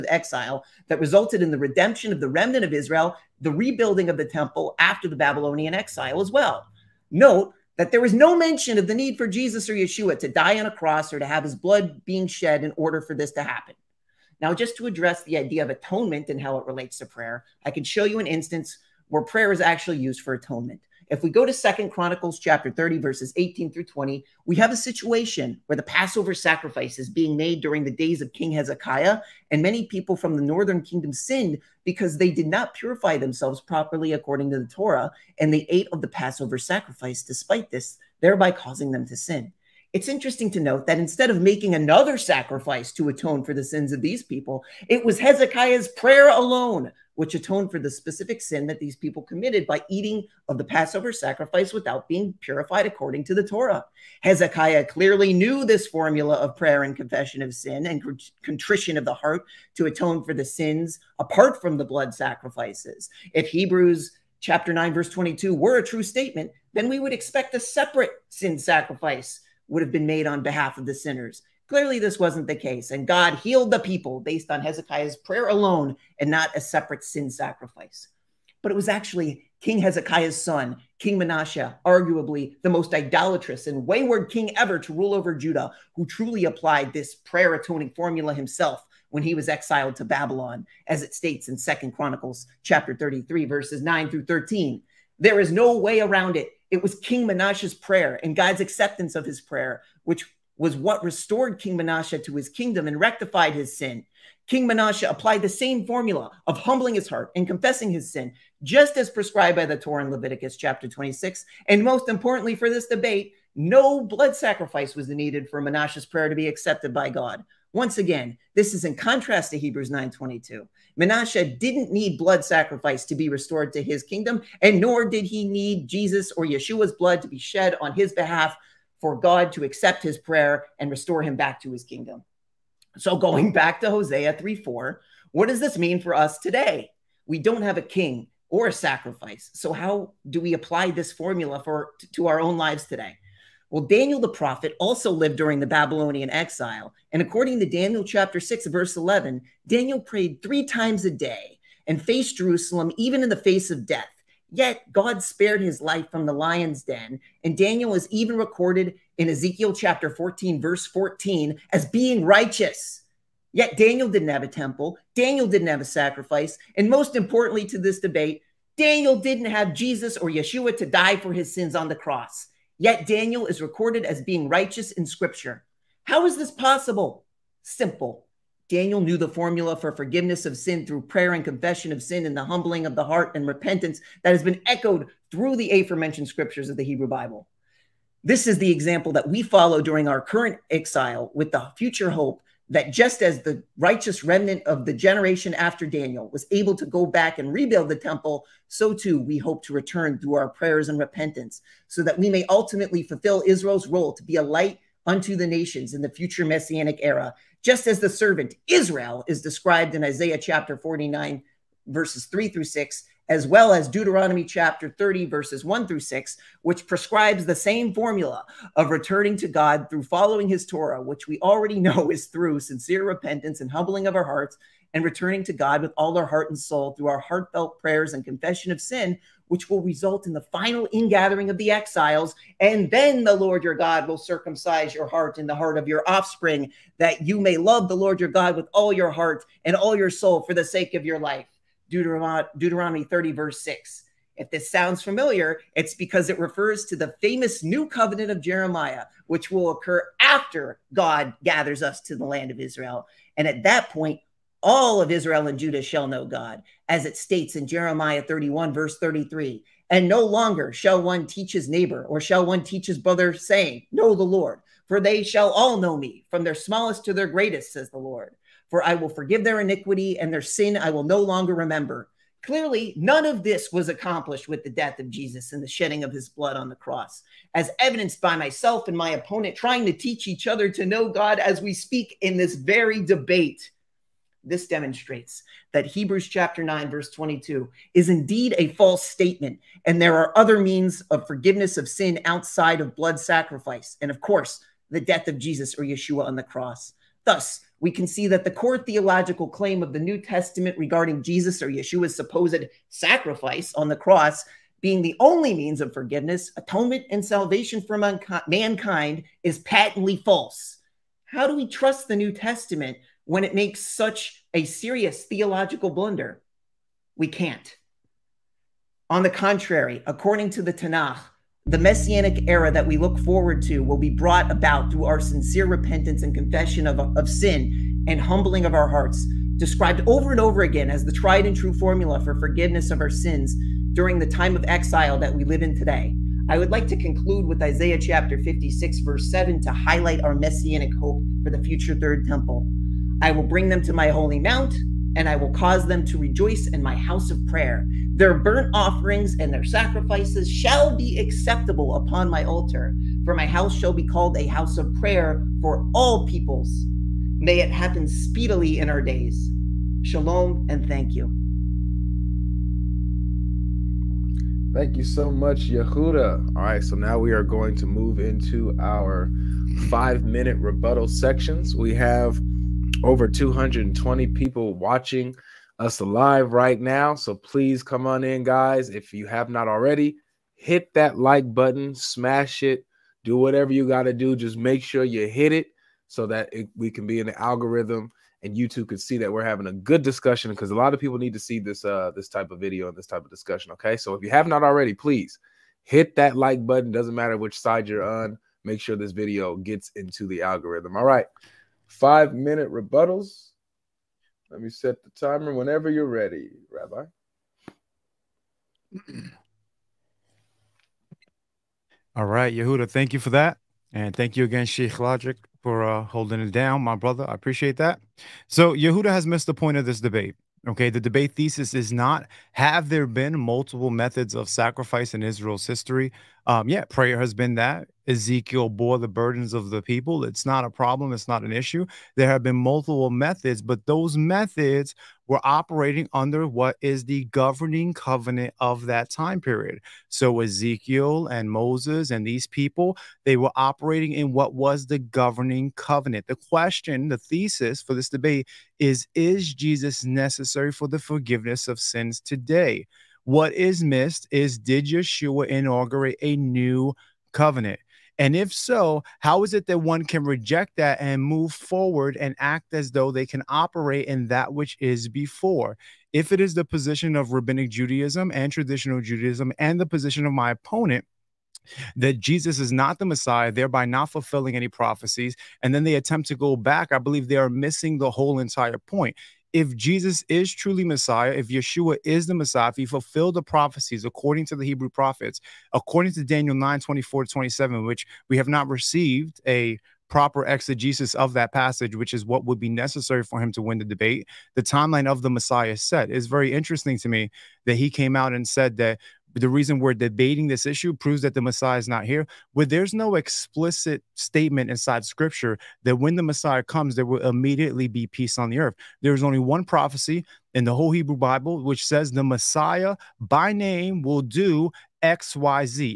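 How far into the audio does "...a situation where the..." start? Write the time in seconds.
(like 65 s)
24 s.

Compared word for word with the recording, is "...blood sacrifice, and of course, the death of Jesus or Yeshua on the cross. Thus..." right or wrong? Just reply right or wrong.
right.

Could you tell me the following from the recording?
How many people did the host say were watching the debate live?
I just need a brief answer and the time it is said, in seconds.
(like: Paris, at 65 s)
220, at 373 s.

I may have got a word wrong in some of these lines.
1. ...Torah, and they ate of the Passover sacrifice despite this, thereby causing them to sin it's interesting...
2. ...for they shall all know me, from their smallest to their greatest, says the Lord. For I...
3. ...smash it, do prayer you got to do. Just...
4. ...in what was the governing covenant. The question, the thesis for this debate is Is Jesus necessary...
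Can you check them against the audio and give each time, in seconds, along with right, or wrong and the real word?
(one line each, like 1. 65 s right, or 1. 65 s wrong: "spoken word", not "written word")
1. 34 s right
2. 264 s right
3. 381 s wrong: "whatever", not "prayer"
4. 444 s right.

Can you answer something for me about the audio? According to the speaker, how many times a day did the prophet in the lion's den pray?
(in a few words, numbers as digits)
3.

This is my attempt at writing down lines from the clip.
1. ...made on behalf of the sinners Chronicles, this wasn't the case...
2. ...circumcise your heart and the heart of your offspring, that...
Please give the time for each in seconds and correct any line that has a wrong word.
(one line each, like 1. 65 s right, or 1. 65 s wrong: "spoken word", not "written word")
1. 70 s wrong: "Clearly", not "Chronicles"
2. 234 s right.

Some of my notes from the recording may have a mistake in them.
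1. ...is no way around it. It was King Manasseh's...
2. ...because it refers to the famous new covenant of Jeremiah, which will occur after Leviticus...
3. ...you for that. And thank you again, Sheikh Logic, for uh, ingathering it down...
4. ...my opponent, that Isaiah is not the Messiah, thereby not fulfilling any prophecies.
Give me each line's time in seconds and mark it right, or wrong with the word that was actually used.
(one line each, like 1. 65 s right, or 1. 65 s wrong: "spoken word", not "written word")
1. 95 s right
2. 245 s wrong: "God", not "Leviticus"
3. 413 s wrong: "holding", not "ingathering"
4. 470 s wrong: "Jesus", not "Isaiah".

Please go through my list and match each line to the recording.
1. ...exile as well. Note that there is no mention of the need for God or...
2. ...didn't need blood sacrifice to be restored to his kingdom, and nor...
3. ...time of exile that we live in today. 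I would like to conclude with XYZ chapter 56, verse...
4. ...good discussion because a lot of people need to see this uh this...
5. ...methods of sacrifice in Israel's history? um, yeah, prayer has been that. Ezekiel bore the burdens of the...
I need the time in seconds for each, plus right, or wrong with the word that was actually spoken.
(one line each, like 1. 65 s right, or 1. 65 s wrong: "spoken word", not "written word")
1. 5 s wrong: "Jesus", not "God"
2. 121 s right
3. 334 s wrong: "Isaiah", not "XYZ"
4. 389 s right
5. 423 s right.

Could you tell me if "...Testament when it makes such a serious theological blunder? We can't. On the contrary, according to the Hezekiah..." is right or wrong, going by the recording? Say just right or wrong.
wrong.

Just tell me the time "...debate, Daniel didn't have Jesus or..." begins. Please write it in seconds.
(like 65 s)
167 s.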